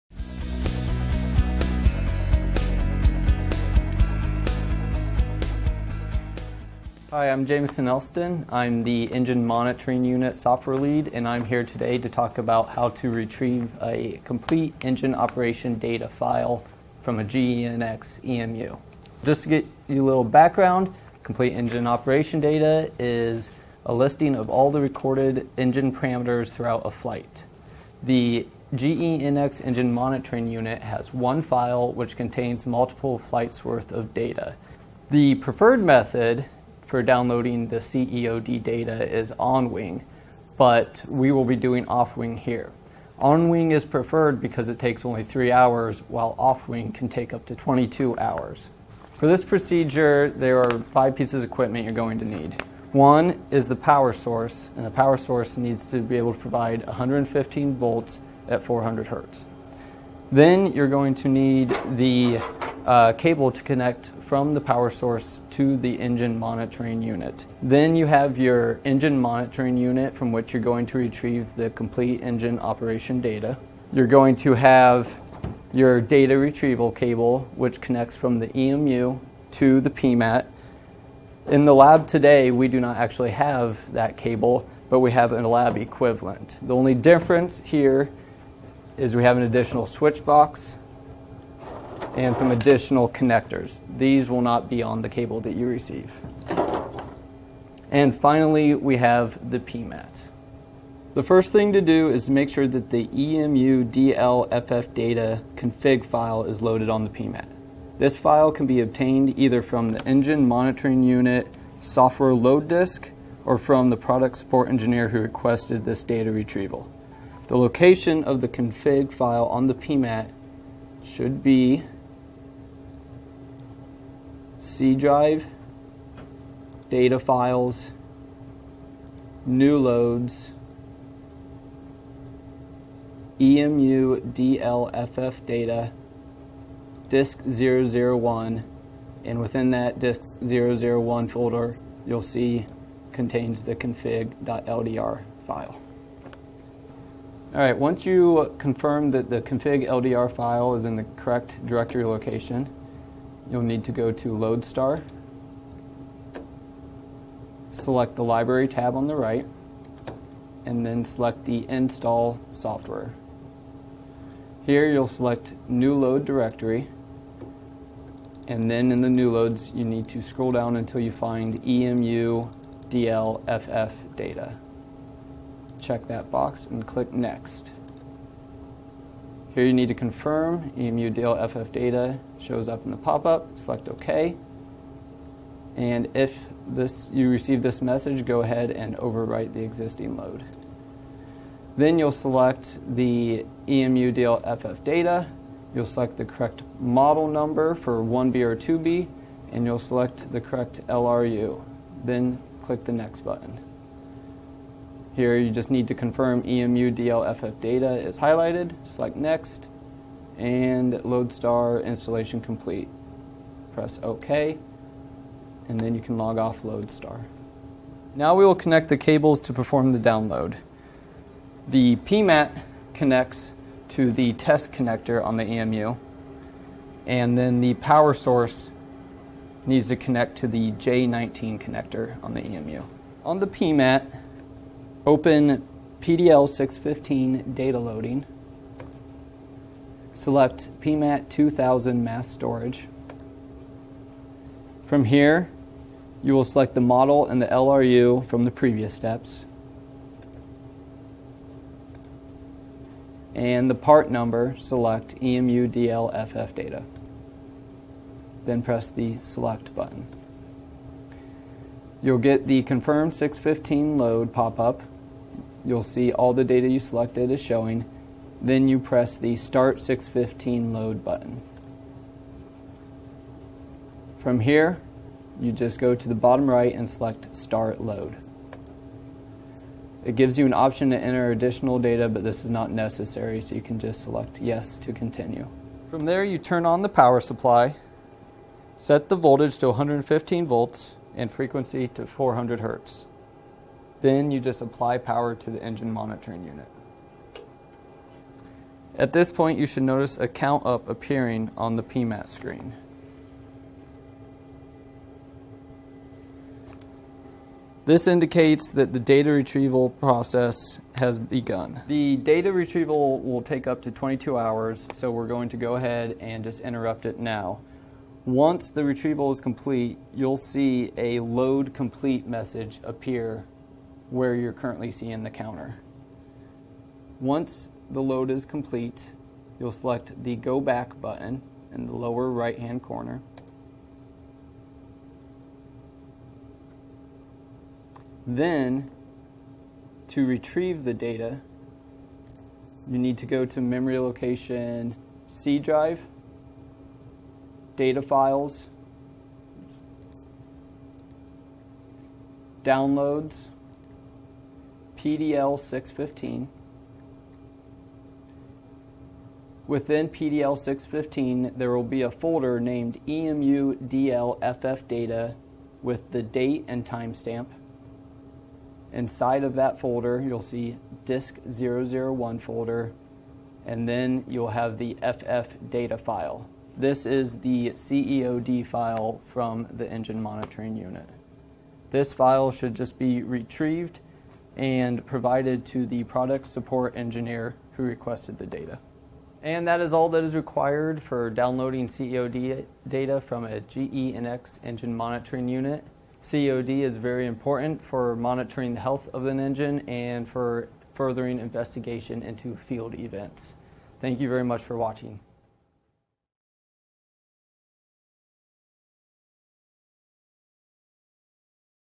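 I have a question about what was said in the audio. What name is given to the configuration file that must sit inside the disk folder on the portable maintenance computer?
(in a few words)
config.ldr.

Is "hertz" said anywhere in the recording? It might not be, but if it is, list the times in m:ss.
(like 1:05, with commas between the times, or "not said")
0:59, 4:52.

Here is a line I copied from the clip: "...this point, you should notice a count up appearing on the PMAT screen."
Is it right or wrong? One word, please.
right.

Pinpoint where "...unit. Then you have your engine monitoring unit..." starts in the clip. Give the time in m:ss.
1:07.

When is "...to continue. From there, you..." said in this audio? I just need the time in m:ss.
4:44.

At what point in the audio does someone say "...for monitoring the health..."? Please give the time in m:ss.
6:37.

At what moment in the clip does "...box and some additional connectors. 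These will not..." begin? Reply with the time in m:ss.
1:30.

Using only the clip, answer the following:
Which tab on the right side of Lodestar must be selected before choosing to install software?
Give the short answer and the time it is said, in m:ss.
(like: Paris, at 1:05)
Library, at 2:38.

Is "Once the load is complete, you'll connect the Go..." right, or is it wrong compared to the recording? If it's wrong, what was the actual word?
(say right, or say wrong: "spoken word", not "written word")
wrong: "select", not "connect".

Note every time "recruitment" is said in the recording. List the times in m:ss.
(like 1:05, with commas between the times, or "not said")
not said.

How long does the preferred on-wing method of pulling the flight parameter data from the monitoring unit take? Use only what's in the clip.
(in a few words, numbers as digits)
3 hours.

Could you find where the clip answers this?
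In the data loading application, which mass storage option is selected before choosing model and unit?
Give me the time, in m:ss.
4:00.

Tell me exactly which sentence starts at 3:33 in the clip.
Press OK, and then you can log off Lodestar.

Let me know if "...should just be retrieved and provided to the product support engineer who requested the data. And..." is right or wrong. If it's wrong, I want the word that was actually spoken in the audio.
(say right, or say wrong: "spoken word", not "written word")
right.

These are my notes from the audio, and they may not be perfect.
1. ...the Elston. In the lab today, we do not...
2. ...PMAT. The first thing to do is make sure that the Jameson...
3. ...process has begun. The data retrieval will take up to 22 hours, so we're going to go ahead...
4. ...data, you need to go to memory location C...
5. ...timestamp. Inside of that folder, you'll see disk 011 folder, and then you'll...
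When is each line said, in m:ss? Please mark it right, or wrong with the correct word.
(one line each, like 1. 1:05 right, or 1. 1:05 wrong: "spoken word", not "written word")
1. 1:19 wrong: "PMAT", not "Elston"
2. 1:39 wrong: "EMU", not "Jameson"
3. 5:09 right
4. 5:40 right
5. 6:06 wrong: "001", not "011".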